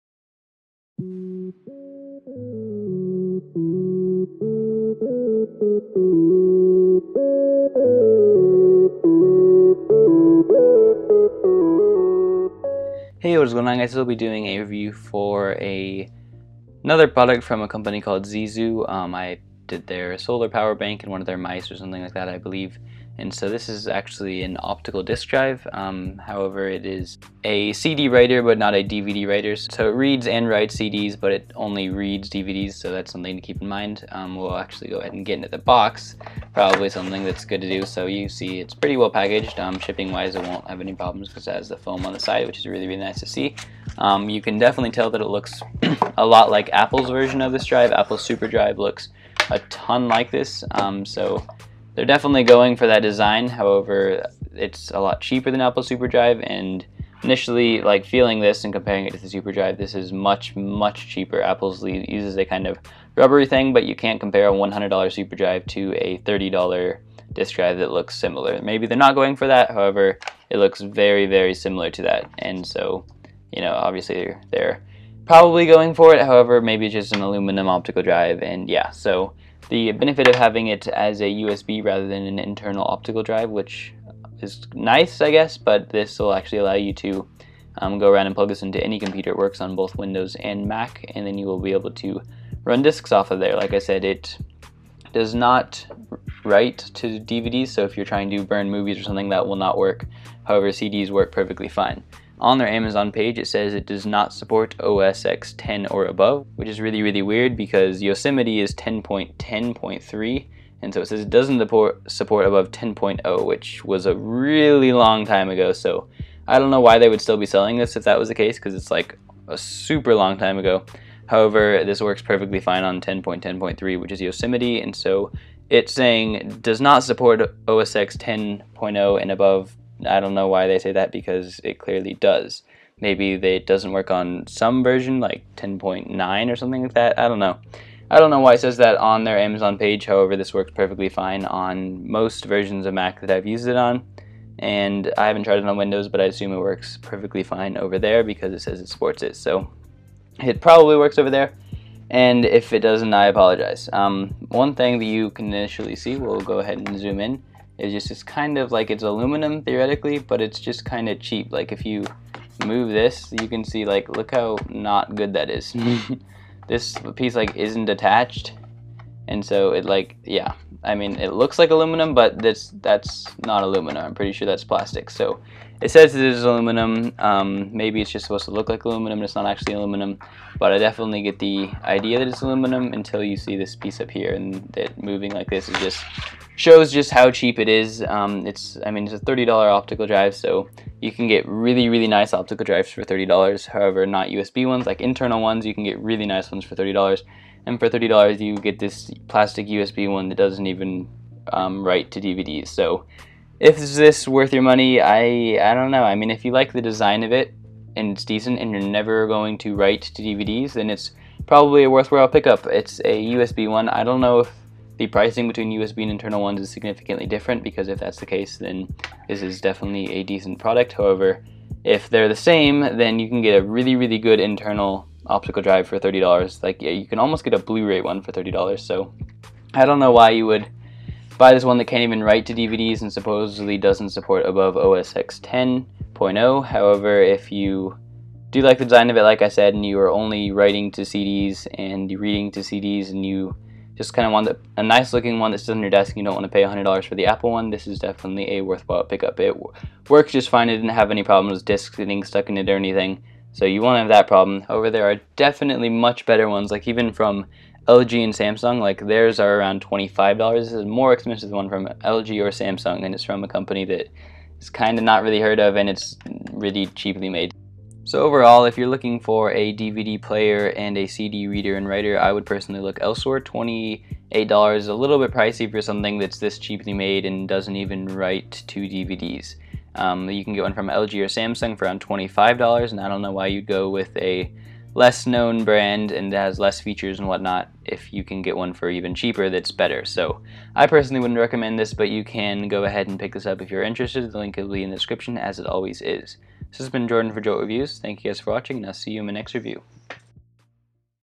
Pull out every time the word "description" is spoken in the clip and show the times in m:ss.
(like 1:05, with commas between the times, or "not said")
4:54.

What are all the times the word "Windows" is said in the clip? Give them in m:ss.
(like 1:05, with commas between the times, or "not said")
1:29, 2:25.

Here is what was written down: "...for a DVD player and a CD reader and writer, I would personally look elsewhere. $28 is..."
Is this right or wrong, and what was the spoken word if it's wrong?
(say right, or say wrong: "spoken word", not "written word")
right.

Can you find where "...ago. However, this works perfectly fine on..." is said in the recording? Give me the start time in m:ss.
2:00.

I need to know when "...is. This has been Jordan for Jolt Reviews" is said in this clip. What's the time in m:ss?
4:56.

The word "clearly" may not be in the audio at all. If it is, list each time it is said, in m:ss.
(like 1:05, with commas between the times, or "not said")
2:11.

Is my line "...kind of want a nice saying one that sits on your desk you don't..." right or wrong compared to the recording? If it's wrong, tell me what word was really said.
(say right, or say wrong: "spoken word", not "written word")
wrong: "looking", not "saying".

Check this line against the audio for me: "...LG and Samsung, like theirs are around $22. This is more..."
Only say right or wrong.
wrong.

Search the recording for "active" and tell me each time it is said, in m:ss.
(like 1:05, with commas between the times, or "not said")
not said.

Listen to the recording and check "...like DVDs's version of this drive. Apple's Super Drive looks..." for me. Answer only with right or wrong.
wrong.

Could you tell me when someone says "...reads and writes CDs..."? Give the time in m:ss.
0:29.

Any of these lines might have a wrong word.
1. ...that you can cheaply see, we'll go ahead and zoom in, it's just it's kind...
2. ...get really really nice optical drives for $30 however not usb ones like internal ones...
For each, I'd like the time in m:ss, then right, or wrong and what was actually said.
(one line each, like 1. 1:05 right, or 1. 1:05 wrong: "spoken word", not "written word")
1. 2:34 wrong: "initially", not "cheaply"
2. 3:11 right.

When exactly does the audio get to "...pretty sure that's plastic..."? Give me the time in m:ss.
2:54.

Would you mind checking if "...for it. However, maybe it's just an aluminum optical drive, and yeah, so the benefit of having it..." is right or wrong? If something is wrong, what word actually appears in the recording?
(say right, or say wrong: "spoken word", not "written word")
right.